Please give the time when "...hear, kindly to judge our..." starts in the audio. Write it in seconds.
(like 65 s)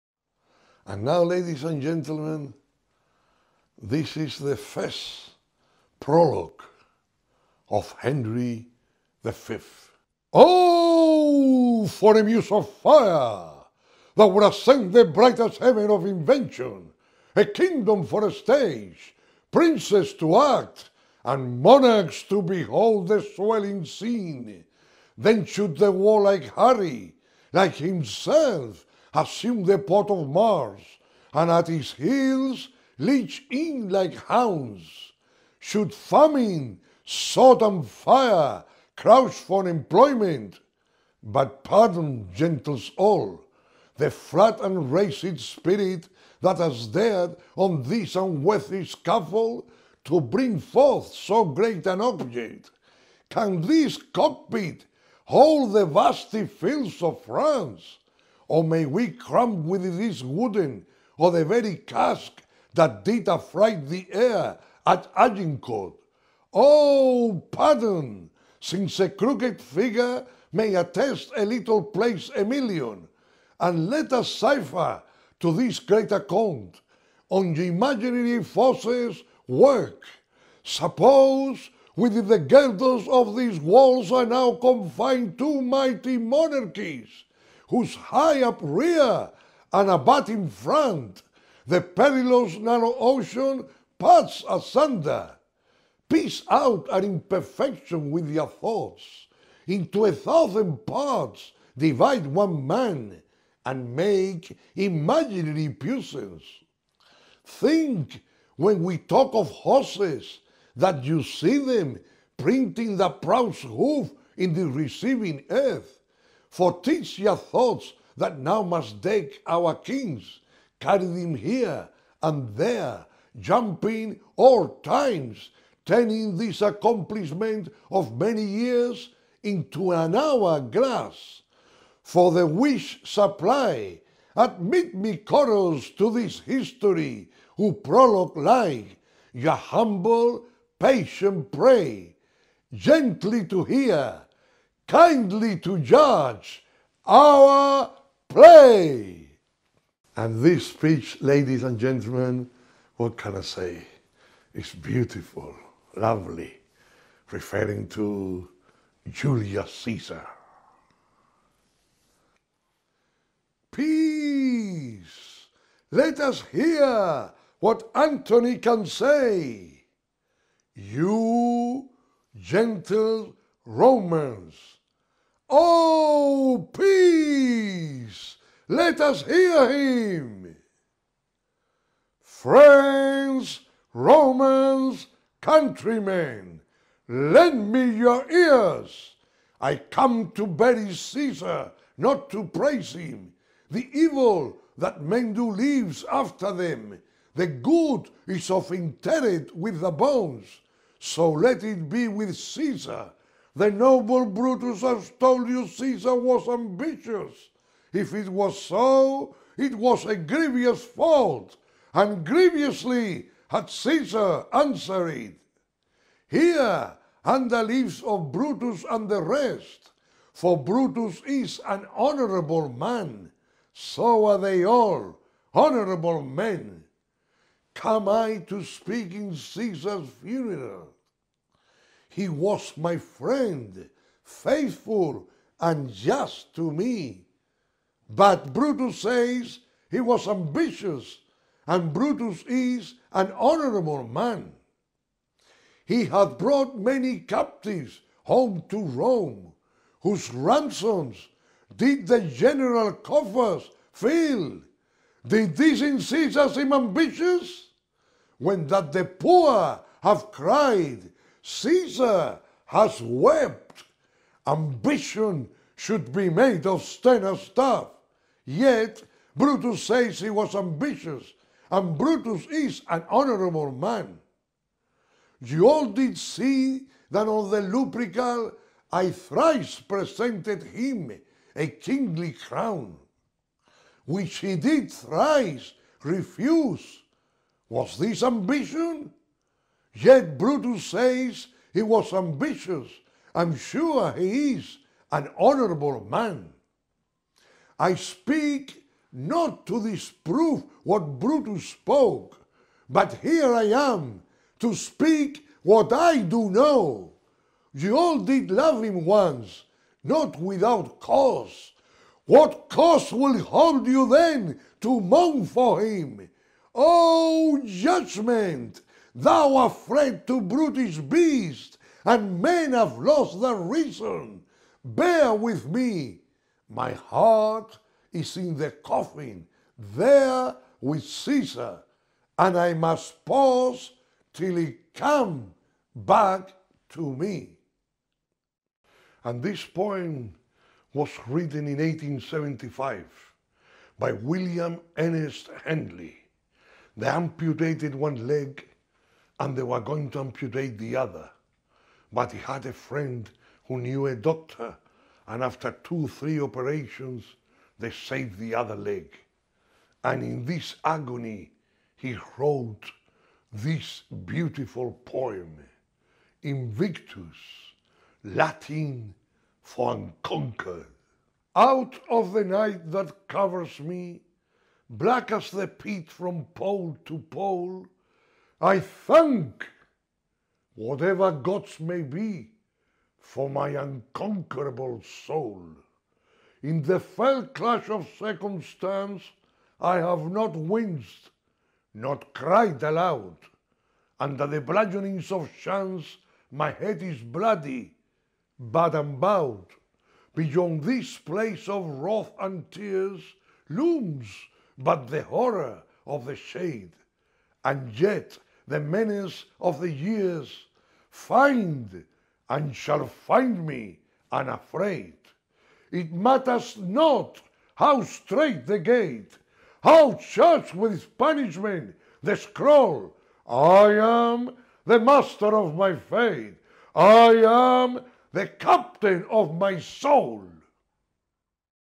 143 s.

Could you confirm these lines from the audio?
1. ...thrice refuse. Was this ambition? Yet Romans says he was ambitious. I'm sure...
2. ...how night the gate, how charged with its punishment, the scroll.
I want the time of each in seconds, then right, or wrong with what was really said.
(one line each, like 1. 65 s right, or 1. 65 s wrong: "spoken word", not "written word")
1. 284 s wrong: "Brutus", not "Romans"
2. 417 s wrong: "straight", not "night".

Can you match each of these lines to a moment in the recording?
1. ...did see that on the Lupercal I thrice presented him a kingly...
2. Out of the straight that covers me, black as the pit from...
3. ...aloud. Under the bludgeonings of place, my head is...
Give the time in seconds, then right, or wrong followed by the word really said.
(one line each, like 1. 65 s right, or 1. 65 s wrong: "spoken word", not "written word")
1. 275 s right
2. 371 s wrong: "night", not "straight"
3. 392 s wrong: "chance", not "place".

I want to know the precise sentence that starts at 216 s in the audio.
Here, under the of Brutus and the rest, for Brutus is an honorable man, so are they all, honorable men.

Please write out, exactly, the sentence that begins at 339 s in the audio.
And this poem was written in 1875 by William Ernest Henley.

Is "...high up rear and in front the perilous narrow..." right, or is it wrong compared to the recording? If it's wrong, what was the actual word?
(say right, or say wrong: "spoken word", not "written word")
right.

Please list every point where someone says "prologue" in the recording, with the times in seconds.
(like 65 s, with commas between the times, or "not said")
5 s, 137 s.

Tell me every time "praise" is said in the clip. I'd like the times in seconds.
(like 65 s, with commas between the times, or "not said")
192 s.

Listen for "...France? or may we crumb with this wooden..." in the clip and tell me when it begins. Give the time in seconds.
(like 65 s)
57 s.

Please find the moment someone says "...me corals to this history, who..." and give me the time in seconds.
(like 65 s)
134 s.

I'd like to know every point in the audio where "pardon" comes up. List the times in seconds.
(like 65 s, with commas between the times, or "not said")
41 s, 67 s.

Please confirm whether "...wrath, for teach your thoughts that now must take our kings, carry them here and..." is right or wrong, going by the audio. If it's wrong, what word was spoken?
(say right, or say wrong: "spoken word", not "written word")
wrong: "earth", not "wrath".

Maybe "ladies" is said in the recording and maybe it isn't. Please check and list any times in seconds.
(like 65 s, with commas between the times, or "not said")
1 s, 151 s.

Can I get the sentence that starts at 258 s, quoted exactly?
When that the poor have cried, Caesar has wept, ambition should be made of sterner stuff.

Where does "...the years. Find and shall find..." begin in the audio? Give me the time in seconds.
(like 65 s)
409 s.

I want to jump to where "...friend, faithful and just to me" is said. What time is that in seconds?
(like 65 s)
232 s.